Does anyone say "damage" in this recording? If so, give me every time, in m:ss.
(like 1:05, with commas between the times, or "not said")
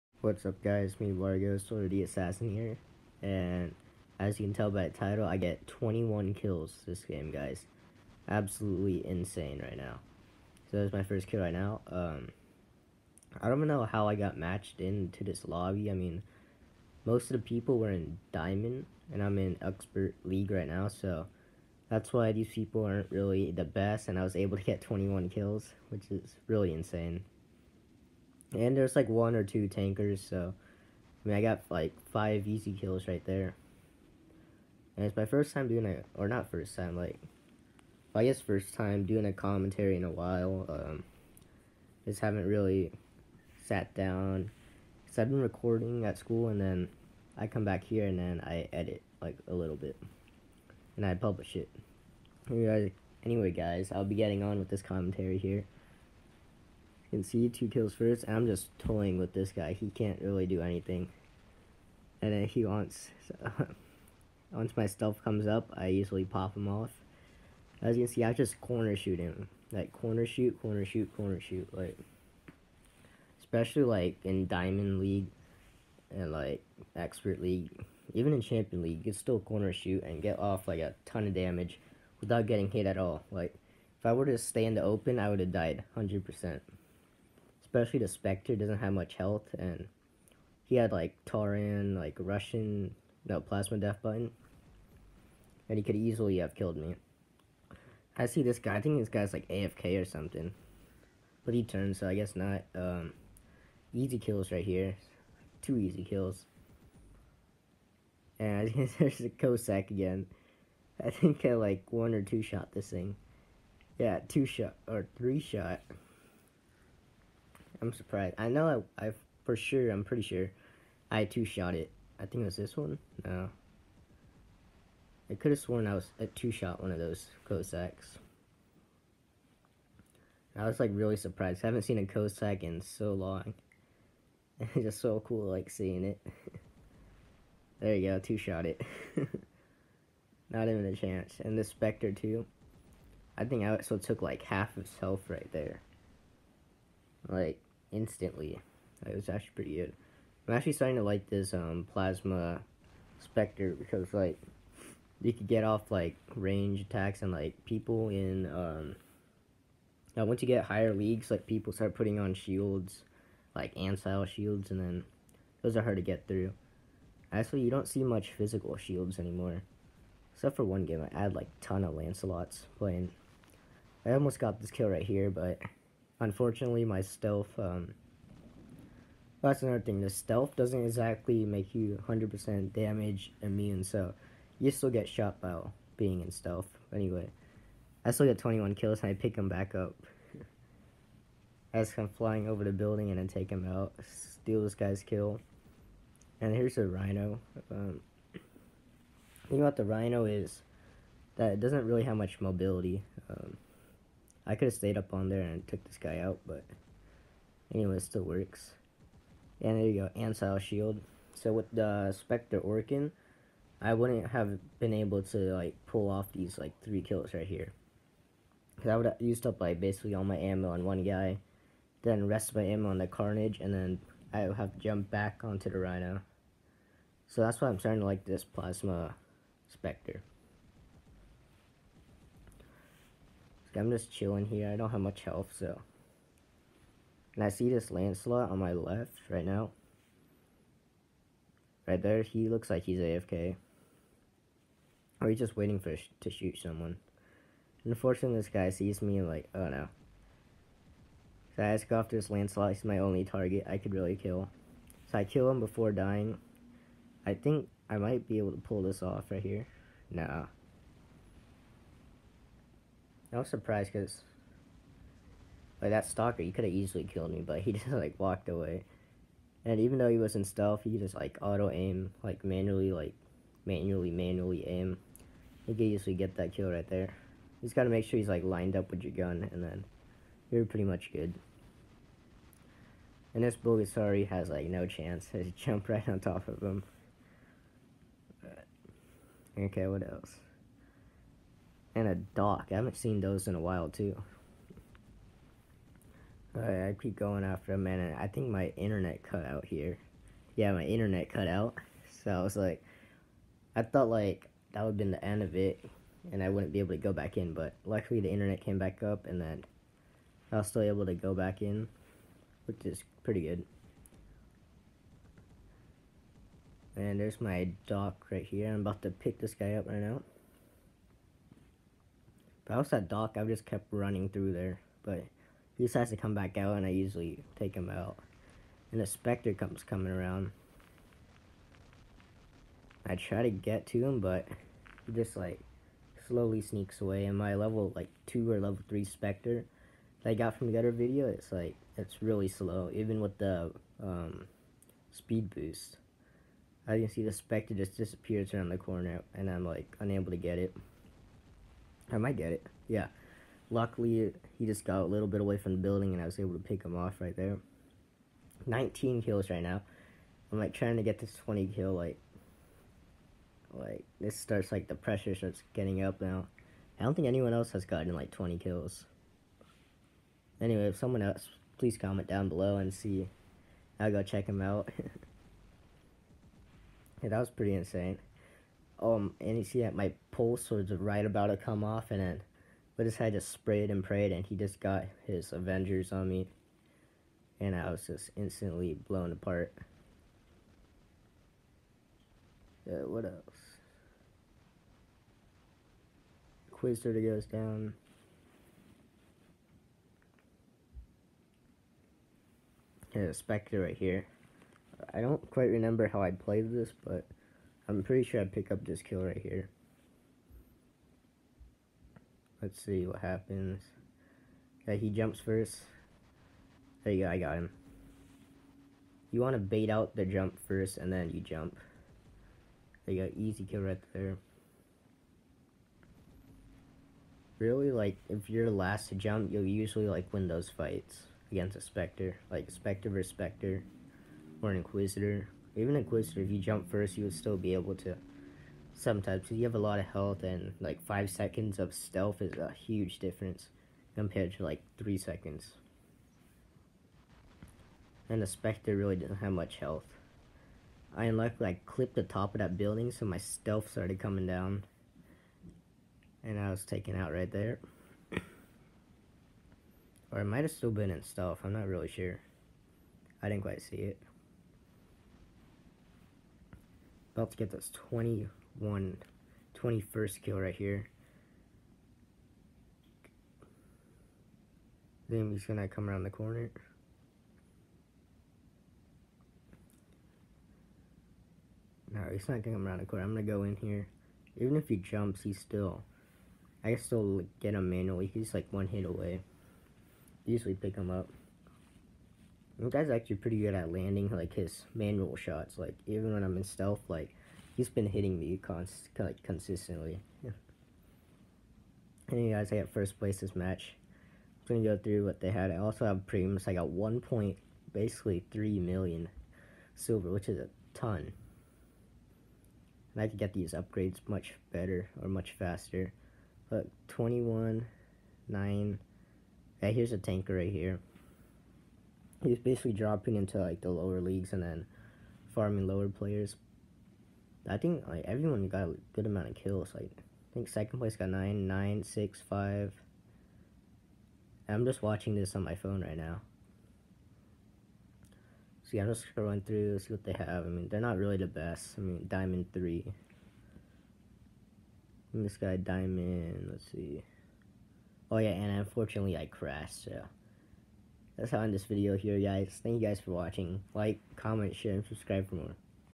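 1:21, 3:02.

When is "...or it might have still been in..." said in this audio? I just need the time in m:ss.
7:40.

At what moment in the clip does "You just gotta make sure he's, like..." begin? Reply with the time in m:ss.
4:37.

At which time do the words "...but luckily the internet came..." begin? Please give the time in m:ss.
5:07.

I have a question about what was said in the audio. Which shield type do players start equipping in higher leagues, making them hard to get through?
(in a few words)
Ancile shields.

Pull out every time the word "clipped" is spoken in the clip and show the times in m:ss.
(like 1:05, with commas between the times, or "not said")
7:31.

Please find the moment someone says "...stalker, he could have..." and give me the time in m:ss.
4:26.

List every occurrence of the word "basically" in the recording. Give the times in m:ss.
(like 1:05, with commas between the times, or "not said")
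3:39, 8:27, 8:42.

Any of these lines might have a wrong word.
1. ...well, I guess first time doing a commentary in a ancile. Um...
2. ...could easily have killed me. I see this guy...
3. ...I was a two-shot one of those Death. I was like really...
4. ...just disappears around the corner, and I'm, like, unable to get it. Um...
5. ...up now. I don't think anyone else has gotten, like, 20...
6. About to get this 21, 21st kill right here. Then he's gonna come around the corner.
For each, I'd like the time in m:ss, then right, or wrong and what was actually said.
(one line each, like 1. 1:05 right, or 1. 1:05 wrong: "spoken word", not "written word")
1. 0:38 wrong: "while", not "ancile"
2. 1:35 right
3. 2:05 wrong: "Cossacks", not "Death"
4. 5:47 right
5. 6:06 right
6. 7:47 right.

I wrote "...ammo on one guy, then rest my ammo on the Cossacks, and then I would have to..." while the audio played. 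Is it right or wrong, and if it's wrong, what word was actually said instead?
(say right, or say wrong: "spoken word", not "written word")
wrong: "Carnage", not "Cossacks".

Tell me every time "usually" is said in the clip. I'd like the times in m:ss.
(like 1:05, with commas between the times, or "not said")
1:05, 5:26, 7:09, 8:10.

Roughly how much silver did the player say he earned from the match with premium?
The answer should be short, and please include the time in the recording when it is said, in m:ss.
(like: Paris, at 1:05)
3 million, at 8:28.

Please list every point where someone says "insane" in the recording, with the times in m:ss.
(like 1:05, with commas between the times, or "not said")
0:09, 0:26, 6:17.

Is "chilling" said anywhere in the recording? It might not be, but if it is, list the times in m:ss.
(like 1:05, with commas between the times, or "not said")
3:54.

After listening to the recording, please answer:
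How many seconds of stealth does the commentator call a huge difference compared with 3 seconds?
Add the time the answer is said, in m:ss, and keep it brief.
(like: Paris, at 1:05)
5, at 7:21.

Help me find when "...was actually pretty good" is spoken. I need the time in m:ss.
2:29.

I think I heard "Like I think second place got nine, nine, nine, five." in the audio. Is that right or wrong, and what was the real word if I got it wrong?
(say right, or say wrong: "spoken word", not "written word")
wrong: "six", not "nine".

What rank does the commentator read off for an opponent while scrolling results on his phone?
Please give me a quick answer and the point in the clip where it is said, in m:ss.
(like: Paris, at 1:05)
Diamond 3, at 9:02.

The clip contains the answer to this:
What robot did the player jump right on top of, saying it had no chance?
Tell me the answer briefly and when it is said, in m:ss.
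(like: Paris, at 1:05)
Bulgasari, at 4:43.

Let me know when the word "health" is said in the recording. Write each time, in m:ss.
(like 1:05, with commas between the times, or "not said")
1:29, 2:24, 3:55, 7:20, 7:29.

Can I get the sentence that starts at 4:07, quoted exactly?
Unfortunately, this guy sees me and like, oh no.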